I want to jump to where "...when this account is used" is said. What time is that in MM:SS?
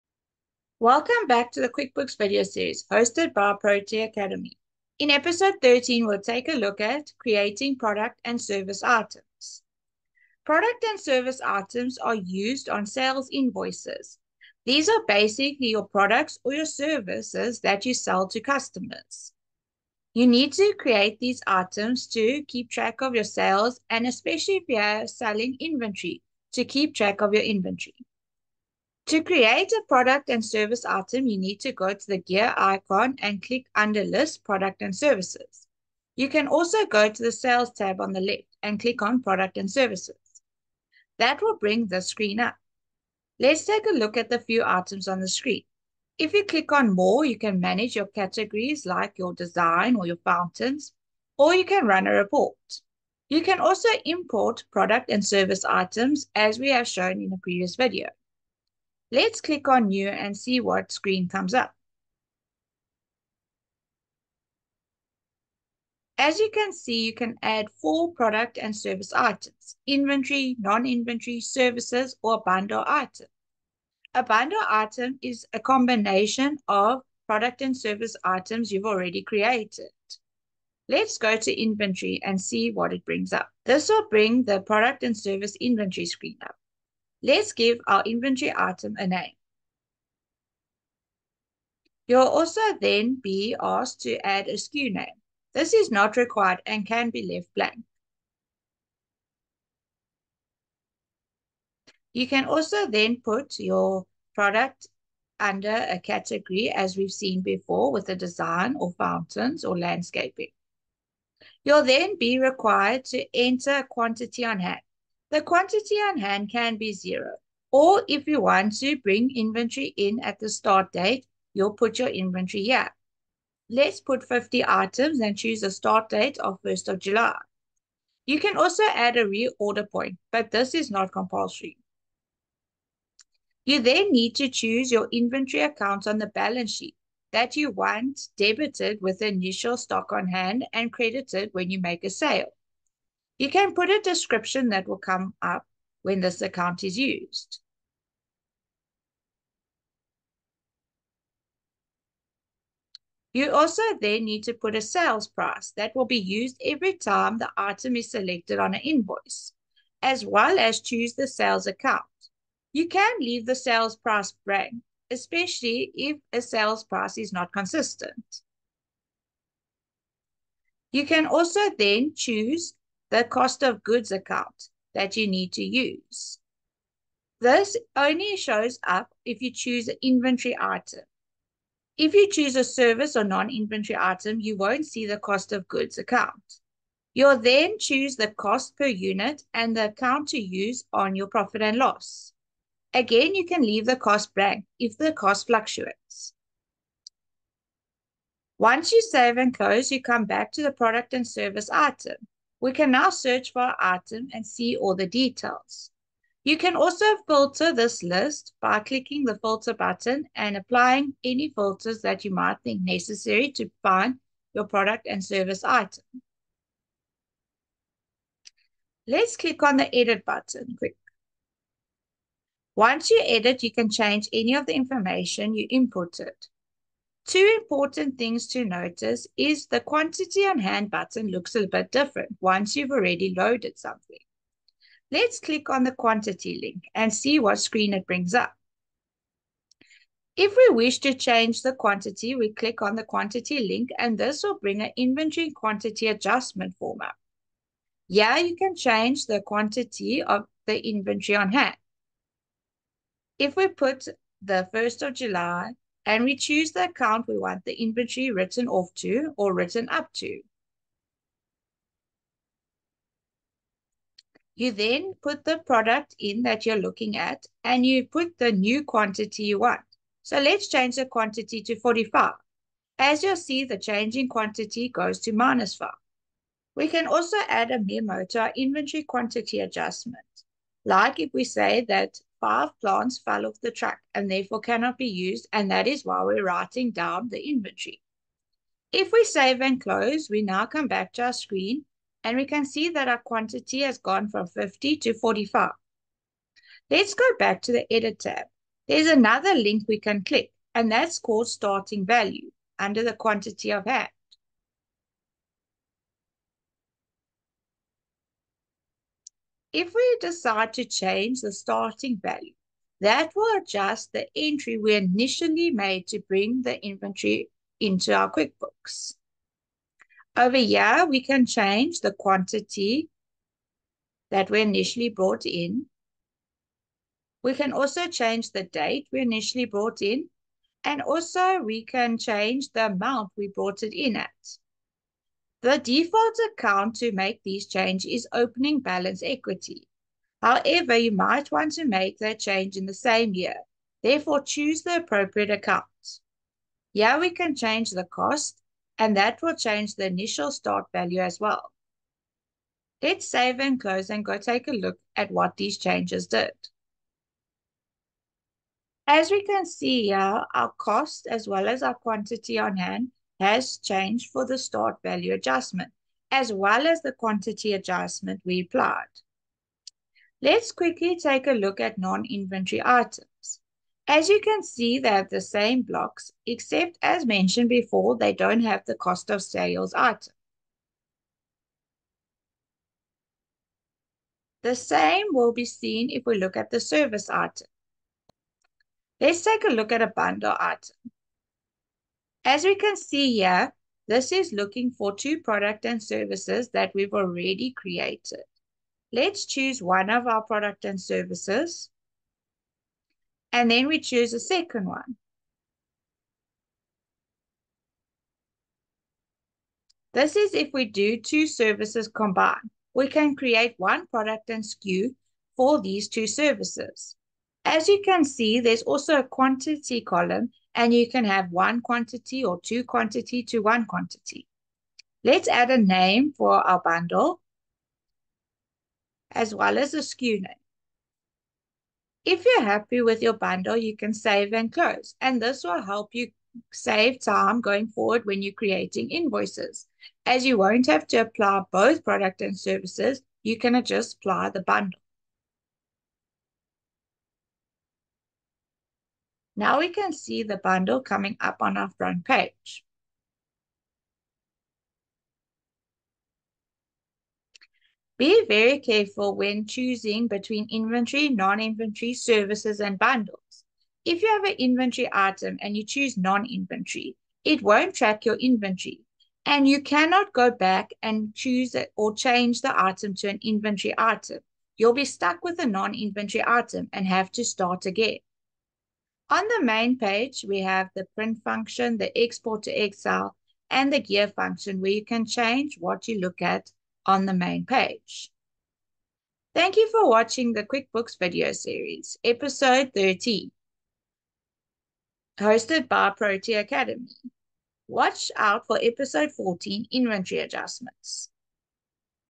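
02:26.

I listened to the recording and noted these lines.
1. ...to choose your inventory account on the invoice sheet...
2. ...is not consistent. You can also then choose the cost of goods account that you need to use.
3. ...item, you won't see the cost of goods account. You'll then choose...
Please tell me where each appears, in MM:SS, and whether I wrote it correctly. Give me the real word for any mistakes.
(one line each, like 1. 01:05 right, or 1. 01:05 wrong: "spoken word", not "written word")
1. 02:14 wrong: "balance", not "invoice"
2. 02:47 right
3. 03:03 right.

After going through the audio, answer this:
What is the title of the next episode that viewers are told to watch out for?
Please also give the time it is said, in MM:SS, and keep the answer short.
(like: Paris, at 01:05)
Inventory Adjustments, at 08:19.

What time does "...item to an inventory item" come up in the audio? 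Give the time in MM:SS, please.
07:52.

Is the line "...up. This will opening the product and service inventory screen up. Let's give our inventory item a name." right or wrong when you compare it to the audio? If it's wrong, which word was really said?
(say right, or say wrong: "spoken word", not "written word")
wrong: "bring", not "opening".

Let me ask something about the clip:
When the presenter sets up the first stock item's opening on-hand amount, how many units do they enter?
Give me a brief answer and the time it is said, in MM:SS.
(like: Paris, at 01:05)
50, at 02:04.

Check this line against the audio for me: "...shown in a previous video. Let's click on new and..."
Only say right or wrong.
right.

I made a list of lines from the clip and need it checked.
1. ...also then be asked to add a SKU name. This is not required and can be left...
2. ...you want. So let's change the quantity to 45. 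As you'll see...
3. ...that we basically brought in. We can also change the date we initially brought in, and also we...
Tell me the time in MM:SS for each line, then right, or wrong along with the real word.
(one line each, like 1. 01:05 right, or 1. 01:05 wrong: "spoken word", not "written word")
1. 01:32 right
2. 04:29 right
3. 05:24 wrong: "initially", not "basically".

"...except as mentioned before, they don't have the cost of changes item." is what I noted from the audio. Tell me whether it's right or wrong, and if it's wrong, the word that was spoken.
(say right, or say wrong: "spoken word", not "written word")
wrong: "sales", not "changes".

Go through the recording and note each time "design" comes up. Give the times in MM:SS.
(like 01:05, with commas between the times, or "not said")
00:49, 01:48.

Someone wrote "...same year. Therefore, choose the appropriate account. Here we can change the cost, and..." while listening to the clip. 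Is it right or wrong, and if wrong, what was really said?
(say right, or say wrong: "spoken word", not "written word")
right.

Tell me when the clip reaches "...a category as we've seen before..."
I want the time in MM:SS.
01:45.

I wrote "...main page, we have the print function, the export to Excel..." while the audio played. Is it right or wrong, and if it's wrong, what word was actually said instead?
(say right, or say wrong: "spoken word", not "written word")
right.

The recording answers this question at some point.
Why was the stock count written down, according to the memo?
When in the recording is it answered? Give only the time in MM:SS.
04:42.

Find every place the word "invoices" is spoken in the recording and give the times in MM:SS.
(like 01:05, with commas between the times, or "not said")
00:13, 02:38, 07:19.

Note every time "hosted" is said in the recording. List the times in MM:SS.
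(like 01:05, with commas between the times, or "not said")
00:02, 08:15.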